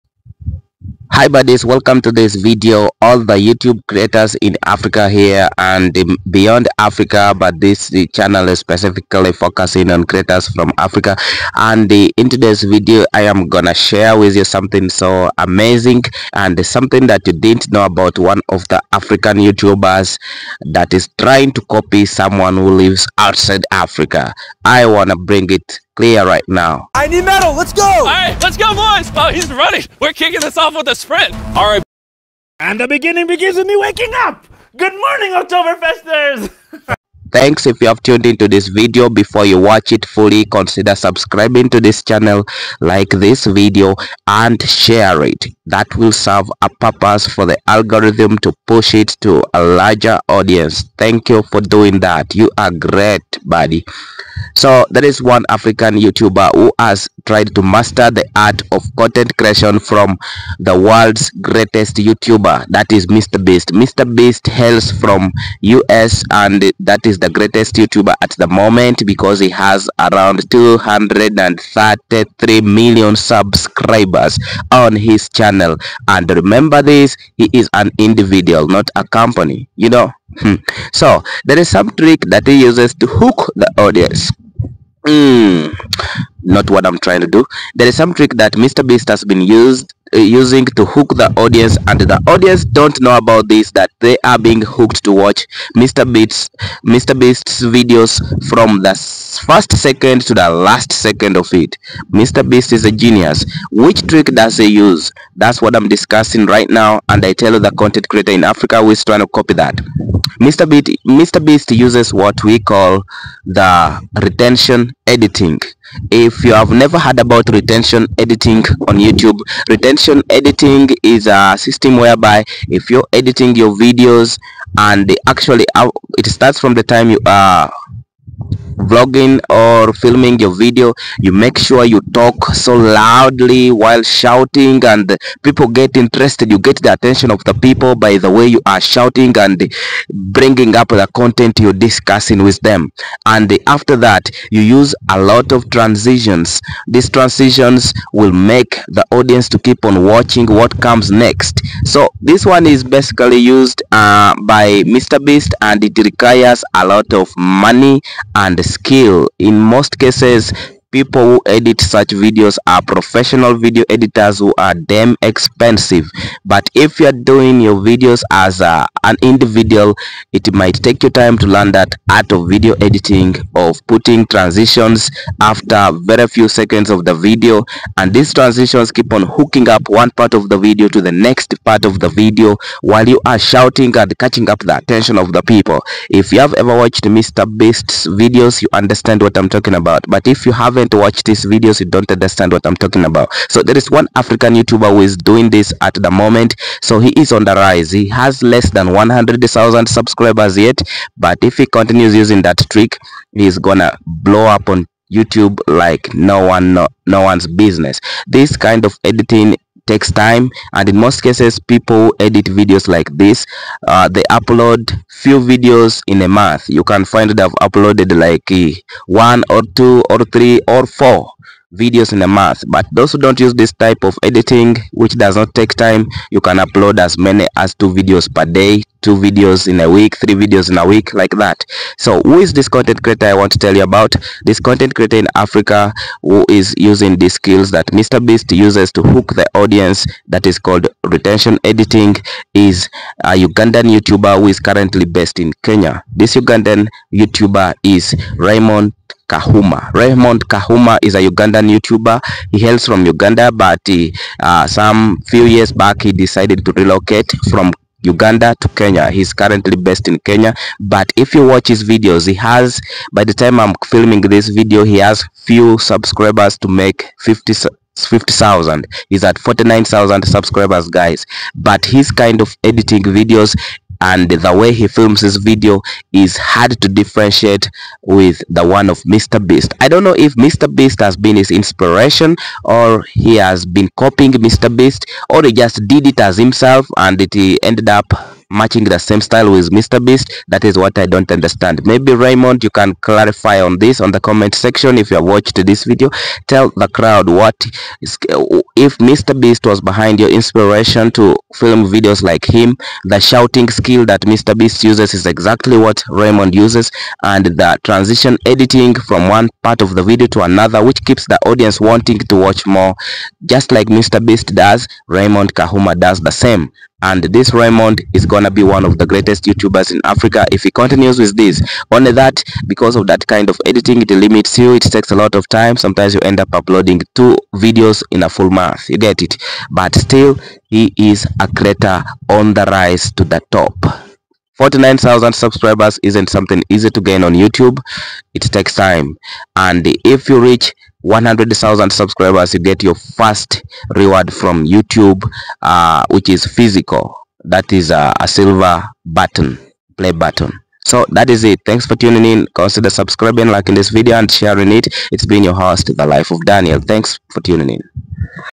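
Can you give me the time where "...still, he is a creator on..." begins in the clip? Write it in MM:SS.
05:29.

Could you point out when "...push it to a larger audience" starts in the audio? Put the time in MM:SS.
00:48.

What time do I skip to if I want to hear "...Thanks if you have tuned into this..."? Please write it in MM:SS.
00:37.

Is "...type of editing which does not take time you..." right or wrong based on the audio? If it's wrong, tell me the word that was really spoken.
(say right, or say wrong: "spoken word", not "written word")
right.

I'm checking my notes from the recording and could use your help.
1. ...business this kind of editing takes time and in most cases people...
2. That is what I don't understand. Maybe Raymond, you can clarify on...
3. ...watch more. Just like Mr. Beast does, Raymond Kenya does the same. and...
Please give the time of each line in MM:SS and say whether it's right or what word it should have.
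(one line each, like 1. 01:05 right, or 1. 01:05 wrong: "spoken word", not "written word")
1. 03:27 right
2. 04:50 right
3. 05:12 wrong: "Kahuma", not "Kenya".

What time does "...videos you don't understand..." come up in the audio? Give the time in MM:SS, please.
03:11.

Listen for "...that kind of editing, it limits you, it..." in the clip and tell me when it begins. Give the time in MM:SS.
05:23.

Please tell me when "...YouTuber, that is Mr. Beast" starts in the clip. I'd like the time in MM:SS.
01:01.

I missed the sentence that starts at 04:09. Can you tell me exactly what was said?
Raymond Kahuma is a Ugandan YouTuber.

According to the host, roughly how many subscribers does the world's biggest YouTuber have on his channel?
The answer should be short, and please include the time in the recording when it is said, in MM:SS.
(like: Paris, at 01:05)
233 million, at 01:10.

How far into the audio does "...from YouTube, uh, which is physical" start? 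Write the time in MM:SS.
05:44.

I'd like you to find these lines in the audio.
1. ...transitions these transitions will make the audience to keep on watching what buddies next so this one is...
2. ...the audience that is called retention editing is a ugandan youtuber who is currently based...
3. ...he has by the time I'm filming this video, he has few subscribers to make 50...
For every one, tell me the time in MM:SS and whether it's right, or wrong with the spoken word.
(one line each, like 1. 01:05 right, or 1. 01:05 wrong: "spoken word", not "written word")
1. 02:25 wrong: "comes", not "buddies"
2. 03:59 right
3. 04:22 right.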